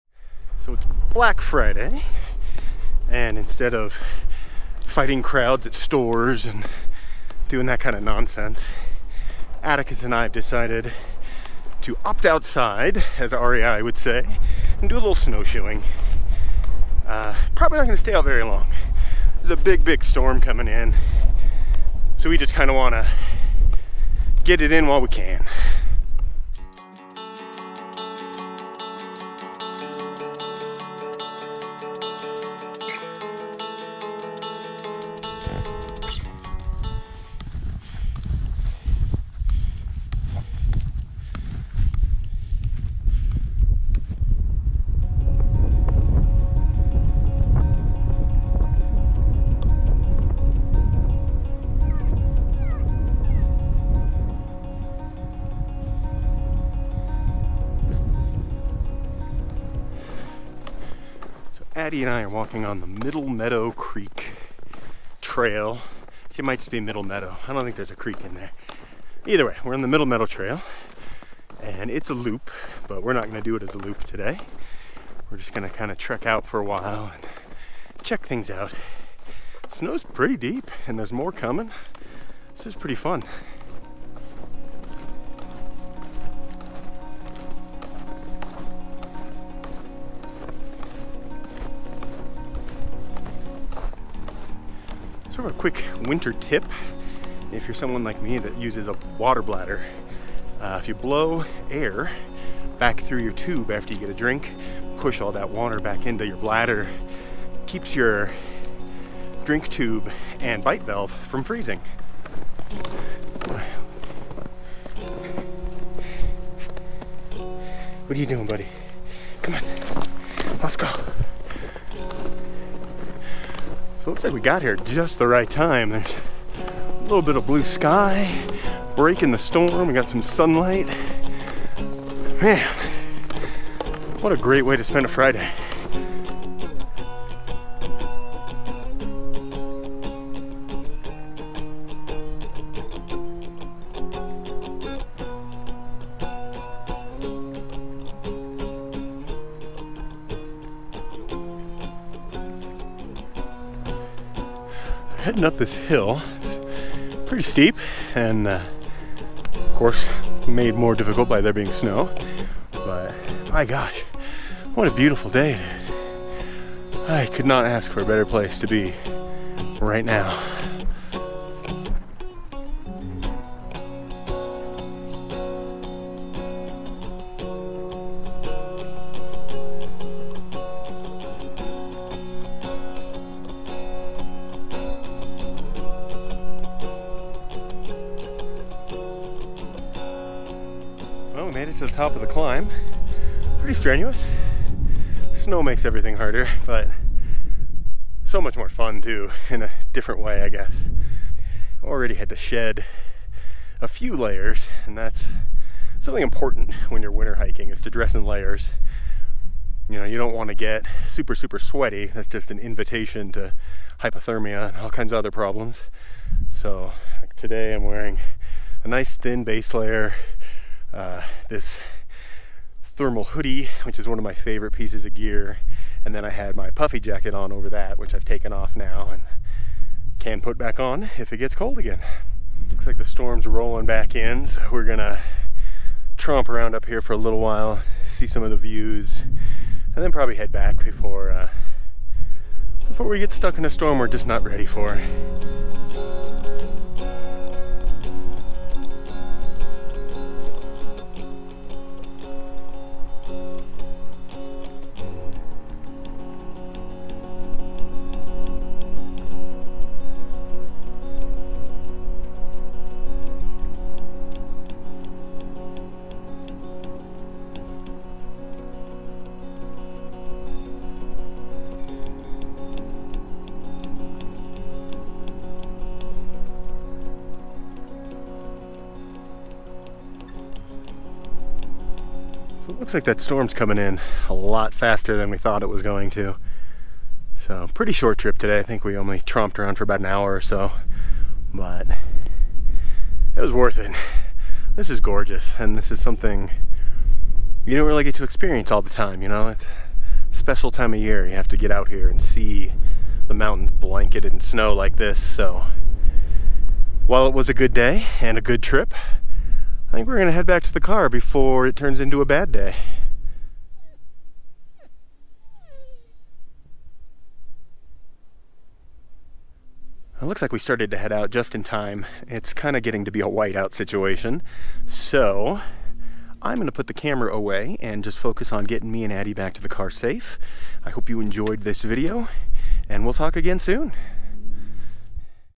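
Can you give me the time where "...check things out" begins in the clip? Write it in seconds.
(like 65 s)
78 s.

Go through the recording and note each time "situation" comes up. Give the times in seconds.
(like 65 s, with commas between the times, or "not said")
323 s.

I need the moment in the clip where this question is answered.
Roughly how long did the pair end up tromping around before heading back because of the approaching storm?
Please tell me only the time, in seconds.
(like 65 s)
289 s.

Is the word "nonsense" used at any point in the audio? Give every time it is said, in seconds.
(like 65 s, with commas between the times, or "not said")
8 s.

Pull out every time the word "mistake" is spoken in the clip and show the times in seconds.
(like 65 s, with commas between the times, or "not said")
not said.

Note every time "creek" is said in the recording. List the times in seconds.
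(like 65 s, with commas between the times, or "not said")
63 s, 67 s.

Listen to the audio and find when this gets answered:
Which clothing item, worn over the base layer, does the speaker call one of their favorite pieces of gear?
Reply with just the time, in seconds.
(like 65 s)
222 s.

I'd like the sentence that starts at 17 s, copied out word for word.
Uh, probably not going to stay out very long.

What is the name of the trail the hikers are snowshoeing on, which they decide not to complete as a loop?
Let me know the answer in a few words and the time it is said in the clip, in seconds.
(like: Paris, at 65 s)
Middle Meadow Trail, at 69 s.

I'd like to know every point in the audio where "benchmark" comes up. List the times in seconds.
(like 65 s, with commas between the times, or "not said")
not said.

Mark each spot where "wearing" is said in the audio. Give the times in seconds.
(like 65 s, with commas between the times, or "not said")
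217 s.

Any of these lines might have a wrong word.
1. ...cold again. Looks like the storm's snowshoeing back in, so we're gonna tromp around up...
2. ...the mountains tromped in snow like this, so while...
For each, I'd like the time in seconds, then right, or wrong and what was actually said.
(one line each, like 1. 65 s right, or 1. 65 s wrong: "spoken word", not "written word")
1. 231 s wrong: "rolling", not "snowshoeing"
2. 303 s wrong: "blanketed", not "tromped".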